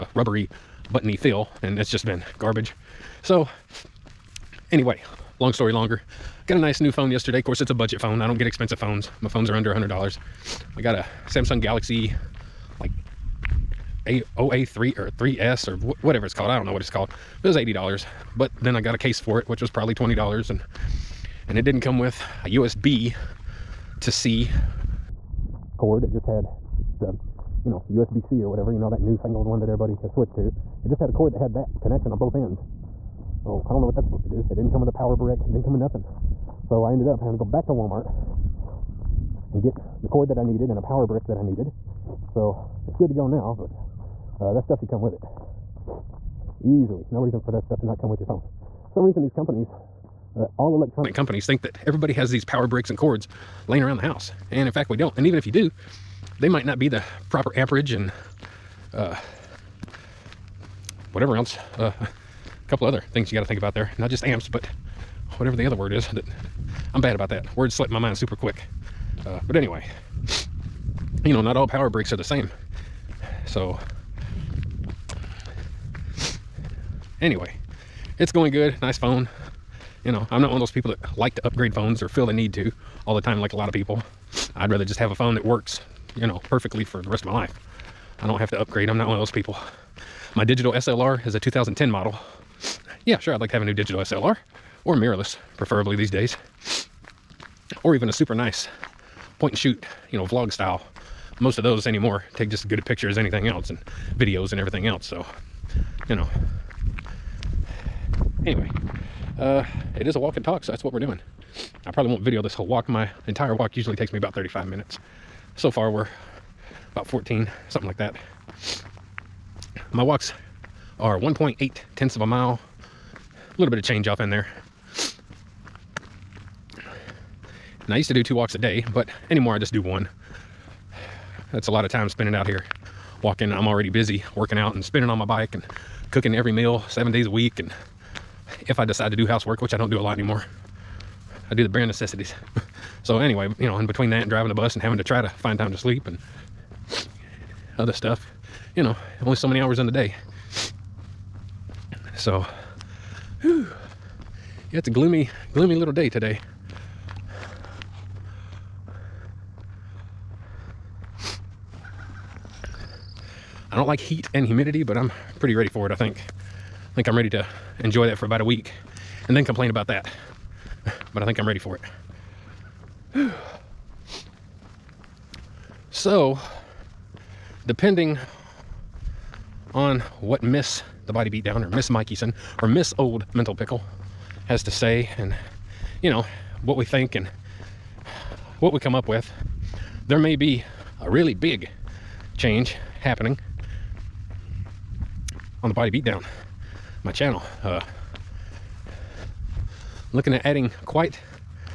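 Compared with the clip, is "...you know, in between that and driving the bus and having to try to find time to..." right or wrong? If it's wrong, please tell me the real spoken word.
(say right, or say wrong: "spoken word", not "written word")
right.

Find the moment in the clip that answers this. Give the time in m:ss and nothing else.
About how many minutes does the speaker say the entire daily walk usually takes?
1:54.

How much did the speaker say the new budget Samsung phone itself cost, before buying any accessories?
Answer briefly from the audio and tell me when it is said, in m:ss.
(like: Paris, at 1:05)
$80, at 0:17.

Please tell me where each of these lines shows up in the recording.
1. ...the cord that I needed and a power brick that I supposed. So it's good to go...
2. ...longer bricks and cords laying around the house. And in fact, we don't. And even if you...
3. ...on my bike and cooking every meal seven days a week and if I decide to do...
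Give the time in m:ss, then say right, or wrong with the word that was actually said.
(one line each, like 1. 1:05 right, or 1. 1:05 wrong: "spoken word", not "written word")
1. 0:40 wrong: "needed", not "supposed"
2. 0:52 wrong: "power", not "longer"
3. 2:15 right.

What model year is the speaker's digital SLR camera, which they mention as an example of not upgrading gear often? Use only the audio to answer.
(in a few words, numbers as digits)
2010.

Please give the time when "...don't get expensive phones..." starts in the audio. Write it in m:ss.
0:08.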